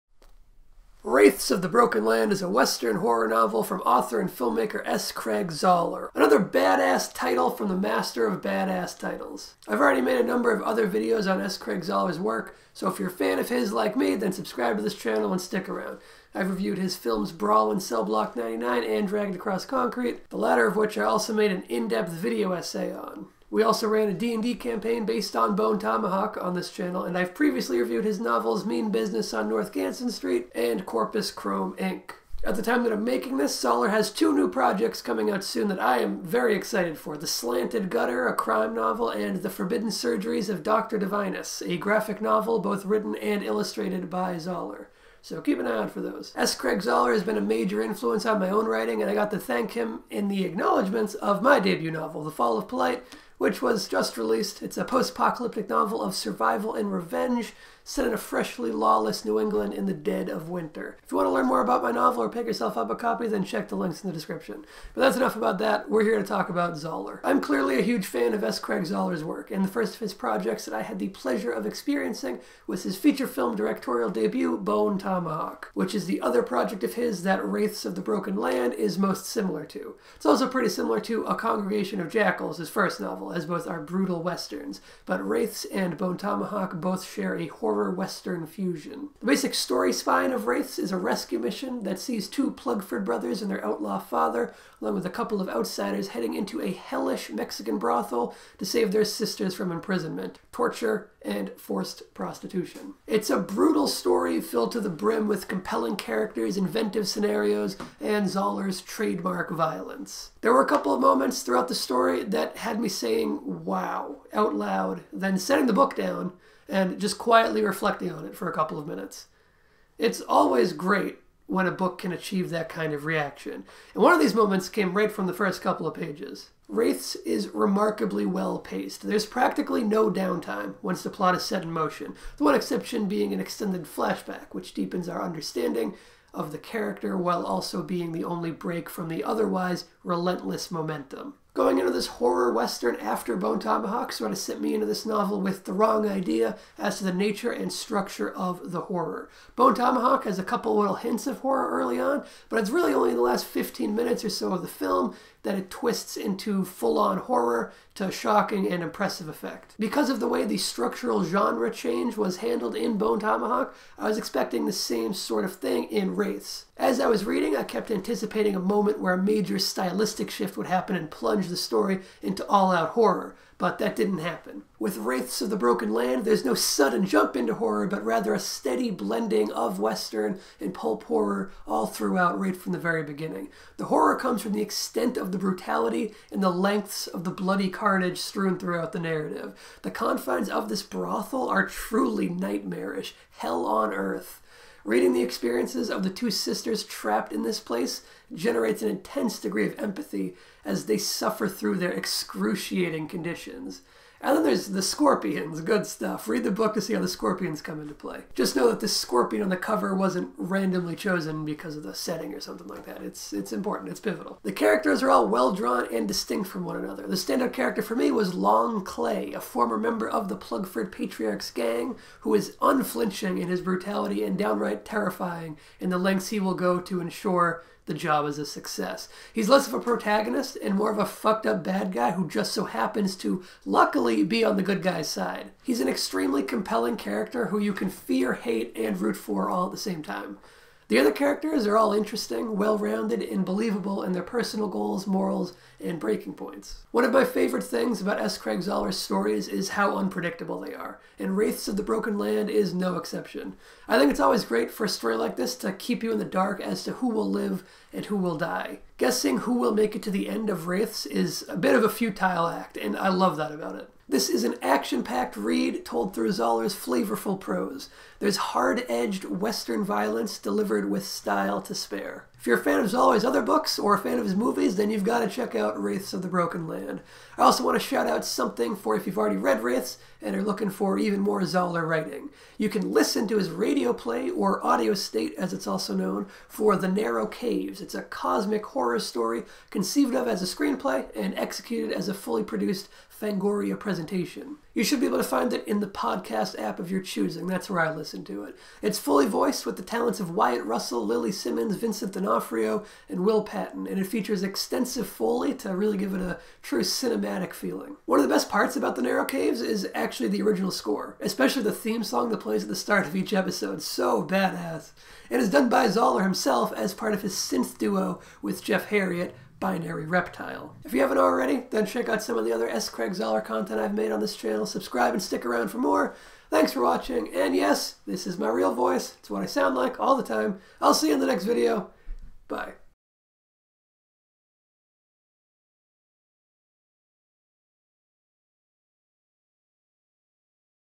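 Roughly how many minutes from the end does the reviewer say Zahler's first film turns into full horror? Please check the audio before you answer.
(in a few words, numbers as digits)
15.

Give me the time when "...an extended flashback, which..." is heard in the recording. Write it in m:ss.
2:13.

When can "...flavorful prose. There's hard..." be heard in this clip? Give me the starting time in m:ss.
4:26.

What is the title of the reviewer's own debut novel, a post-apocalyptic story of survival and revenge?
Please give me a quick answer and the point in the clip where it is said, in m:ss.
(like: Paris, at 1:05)
The Fall of Polite, at 0:52.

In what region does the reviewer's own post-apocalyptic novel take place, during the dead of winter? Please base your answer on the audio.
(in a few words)
New England.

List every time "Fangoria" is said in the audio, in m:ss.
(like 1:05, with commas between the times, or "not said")
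4:53.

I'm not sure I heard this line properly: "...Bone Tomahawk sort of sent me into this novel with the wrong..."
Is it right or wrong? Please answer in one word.
right.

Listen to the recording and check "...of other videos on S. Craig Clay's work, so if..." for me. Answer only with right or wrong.
wrong.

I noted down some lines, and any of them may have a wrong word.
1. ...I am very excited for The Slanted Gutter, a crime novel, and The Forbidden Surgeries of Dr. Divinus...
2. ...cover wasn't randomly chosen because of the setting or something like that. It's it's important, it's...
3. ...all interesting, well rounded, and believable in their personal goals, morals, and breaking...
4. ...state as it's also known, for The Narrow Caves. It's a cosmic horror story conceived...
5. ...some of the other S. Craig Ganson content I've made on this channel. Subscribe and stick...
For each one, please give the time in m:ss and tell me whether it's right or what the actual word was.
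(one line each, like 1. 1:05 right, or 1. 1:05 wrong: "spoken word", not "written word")
1. 0:35 right
2. 3:29 right
3. 4:01 right
4. 4:44 right
5. 5:22 wrong: "Zahler", not "Ganson".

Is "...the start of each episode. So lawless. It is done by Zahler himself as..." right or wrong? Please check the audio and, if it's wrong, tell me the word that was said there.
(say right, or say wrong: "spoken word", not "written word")
wrong: "badass", not "lawless".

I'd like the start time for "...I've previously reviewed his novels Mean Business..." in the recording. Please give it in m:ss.
0:27.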